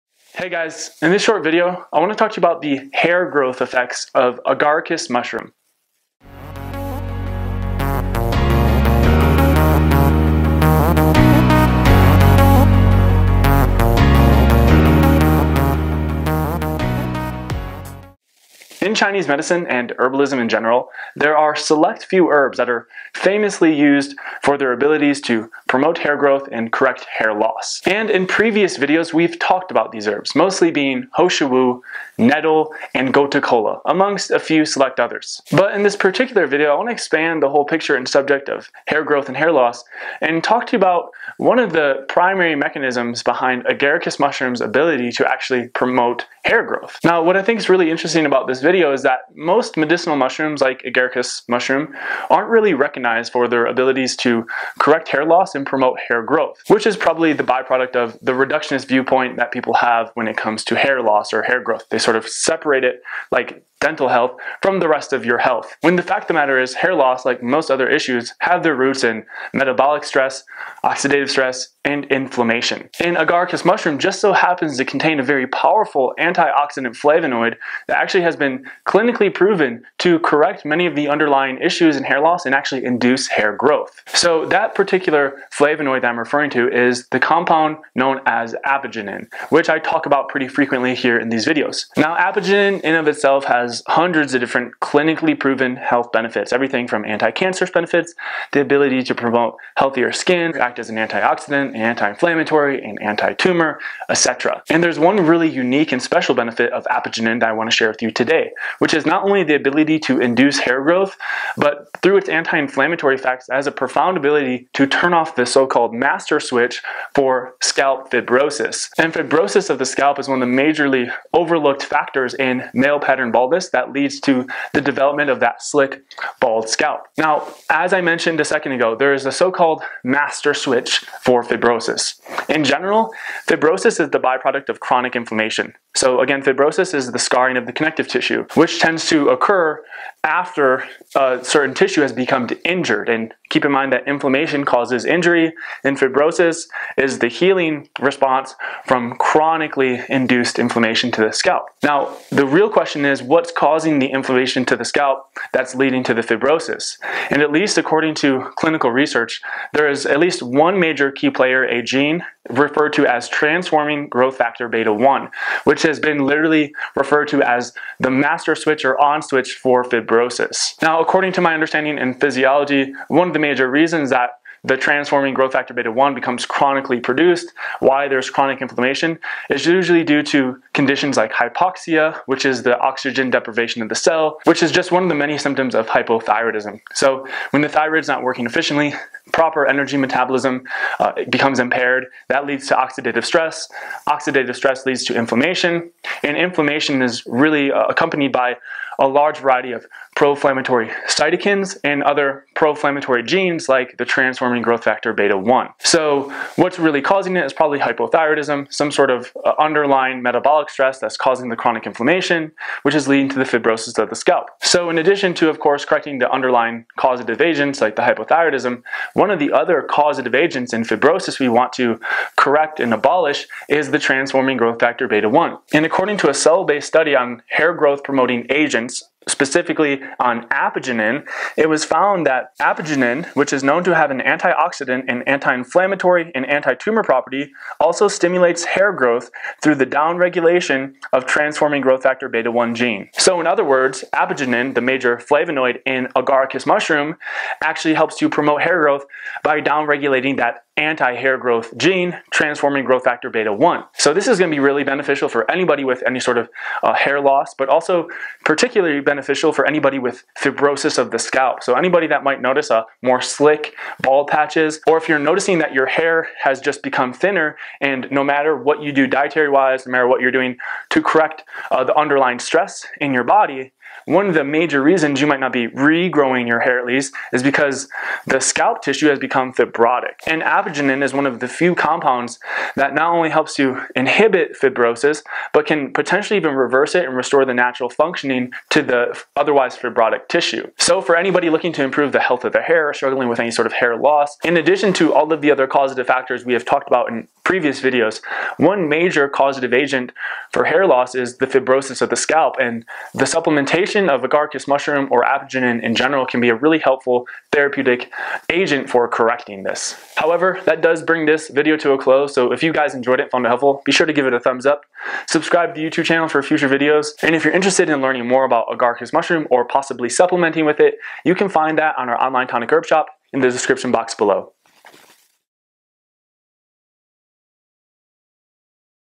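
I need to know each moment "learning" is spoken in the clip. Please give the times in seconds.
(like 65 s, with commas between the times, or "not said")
318 s.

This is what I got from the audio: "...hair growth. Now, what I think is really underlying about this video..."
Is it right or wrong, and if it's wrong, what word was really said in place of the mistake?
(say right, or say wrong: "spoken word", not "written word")
wrong: "interesting", not "underlying".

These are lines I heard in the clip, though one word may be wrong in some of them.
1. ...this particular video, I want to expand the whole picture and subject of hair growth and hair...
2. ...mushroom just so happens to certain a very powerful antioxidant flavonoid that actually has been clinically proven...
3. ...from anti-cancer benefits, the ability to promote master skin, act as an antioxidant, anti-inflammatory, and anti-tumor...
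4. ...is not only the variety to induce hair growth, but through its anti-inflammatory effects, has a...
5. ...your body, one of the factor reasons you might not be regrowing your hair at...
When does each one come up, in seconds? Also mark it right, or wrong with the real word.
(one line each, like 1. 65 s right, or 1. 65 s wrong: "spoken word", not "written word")
1. 35 s right
2. 73 s wrong: "contain", not "certain"
3. 96 s wrong: "healthier", not "master"
4. 108 s wrong: "ability", not "variety"
5. 273 s wrong: "major", not "factor".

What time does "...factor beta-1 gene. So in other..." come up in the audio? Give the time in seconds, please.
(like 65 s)
242 s.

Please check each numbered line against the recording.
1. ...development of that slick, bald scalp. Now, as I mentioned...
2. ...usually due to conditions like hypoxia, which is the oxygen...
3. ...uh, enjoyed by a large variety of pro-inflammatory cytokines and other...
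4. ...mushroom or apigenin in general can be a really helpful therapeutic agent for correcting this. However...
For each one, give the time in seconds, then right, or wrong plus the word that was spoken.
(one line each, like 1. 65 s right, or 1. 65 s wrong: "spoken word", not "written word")
1. 124 s right
2. 179 s right
3. 197 s wrong: "accompanied", not "enjoyed"
4. 304 s right.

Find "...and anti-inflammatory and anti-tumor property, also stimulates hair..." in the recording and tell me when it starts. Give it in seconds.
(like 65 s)
235 s.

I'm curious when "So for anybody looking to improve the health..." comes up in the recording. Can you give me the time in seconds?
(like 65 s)
290 s.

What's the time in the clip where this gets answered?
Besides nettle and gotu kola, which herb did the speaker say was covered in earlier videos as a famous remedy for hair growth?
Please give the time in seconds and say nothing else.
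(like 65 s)
31 s.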